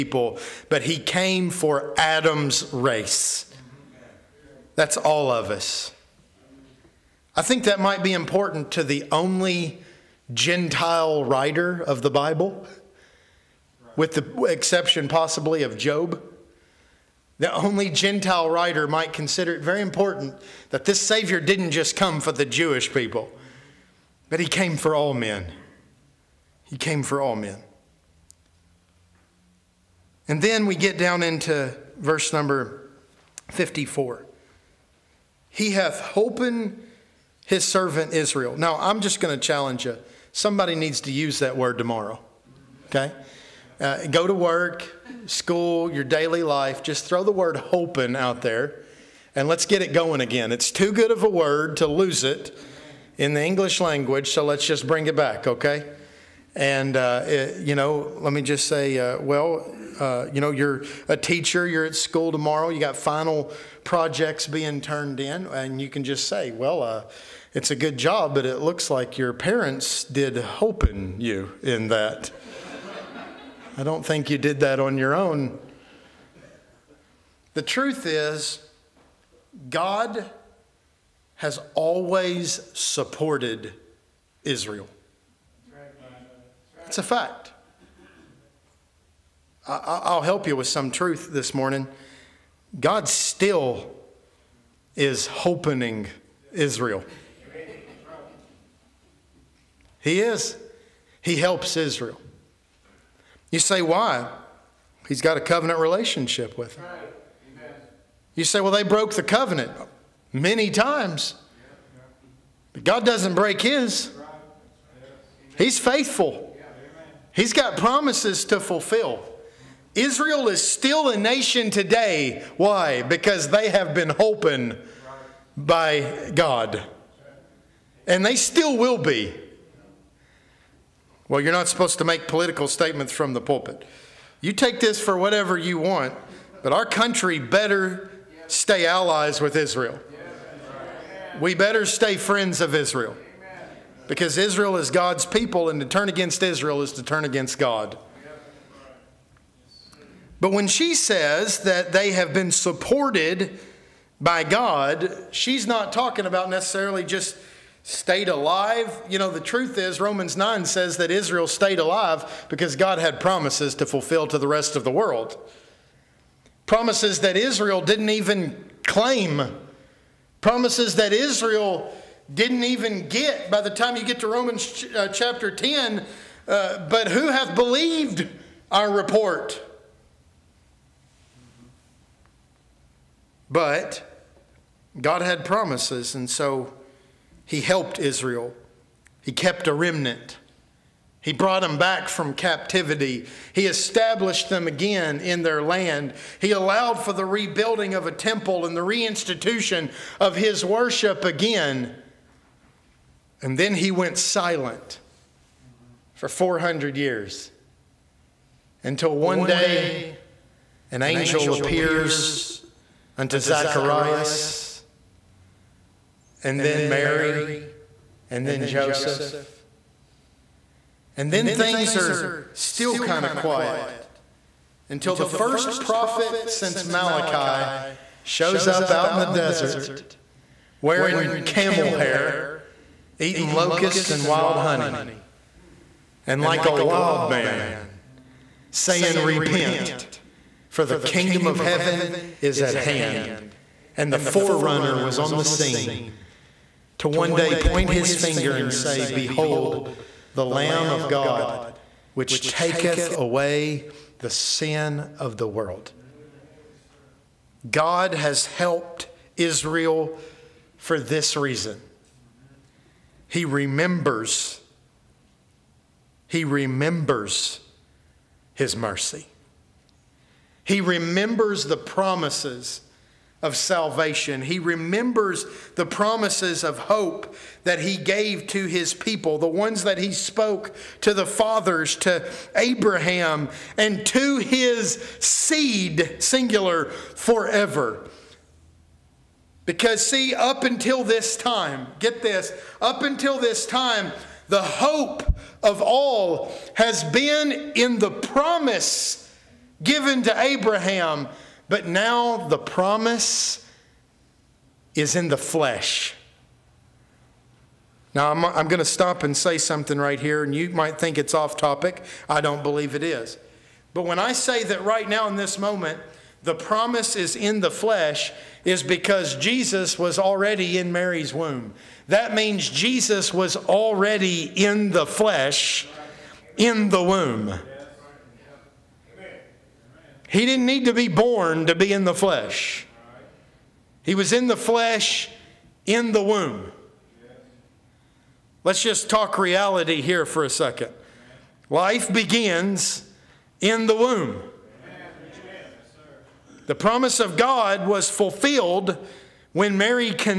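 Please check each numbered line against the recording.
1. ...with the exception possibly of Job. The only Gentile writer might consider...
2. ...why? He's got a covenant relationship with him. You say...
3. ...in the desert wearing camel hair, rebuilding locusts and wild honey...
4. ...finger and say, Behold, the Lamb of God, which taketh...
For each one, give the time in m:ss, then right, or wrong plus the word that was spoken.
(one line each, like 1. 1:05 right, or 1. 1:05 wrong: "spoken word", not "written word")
1. 0:13 right
2. 1:43 right
3. 3:49 wrong: "eating", not "rebuilding"
4. 4:08 right.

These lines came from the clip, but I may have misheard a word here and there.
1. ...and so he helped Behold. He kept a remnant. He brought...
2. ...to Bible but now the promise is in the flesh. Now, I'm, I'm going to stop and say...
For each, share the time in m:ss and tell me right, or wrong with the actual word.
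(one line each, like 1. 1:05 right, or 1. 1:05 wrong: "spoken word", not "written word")
1. 3:06 wrong: "Israel", not "Behold"
2. 5:00 wrong: "Abraham", not "Bible".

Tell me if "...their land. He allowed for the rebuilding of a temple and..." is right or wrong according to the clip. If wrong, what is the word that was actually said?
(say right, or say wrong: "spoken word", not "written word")
right.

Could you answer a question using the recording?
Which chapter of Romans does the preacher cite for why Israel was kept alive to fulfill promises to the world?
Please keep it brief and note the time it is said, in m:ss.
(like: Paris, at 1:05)
Romans 9, at 2:40.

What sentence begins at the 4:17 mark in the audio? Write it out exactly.
God has helped Israel for this reason.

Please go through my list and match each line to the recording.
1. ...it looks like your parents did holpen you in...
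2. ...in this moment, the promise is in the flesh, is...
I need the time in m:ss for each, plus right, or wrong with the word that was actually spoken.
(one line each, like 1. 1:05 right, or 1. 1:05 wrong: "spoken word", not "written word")
1. 1:08 right
2. 5:15 right.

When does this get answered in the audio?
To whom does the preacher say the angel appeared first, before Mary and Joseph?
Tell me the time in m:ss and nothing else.
3:33.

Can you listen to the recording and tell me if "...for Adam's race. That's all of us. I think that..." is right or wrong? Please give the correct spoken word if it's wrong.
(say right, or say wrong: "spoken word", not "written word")
right.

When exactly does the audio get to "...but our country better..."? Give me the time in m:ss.
2:16.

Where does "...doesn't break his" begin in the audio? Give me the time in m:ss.
1:53.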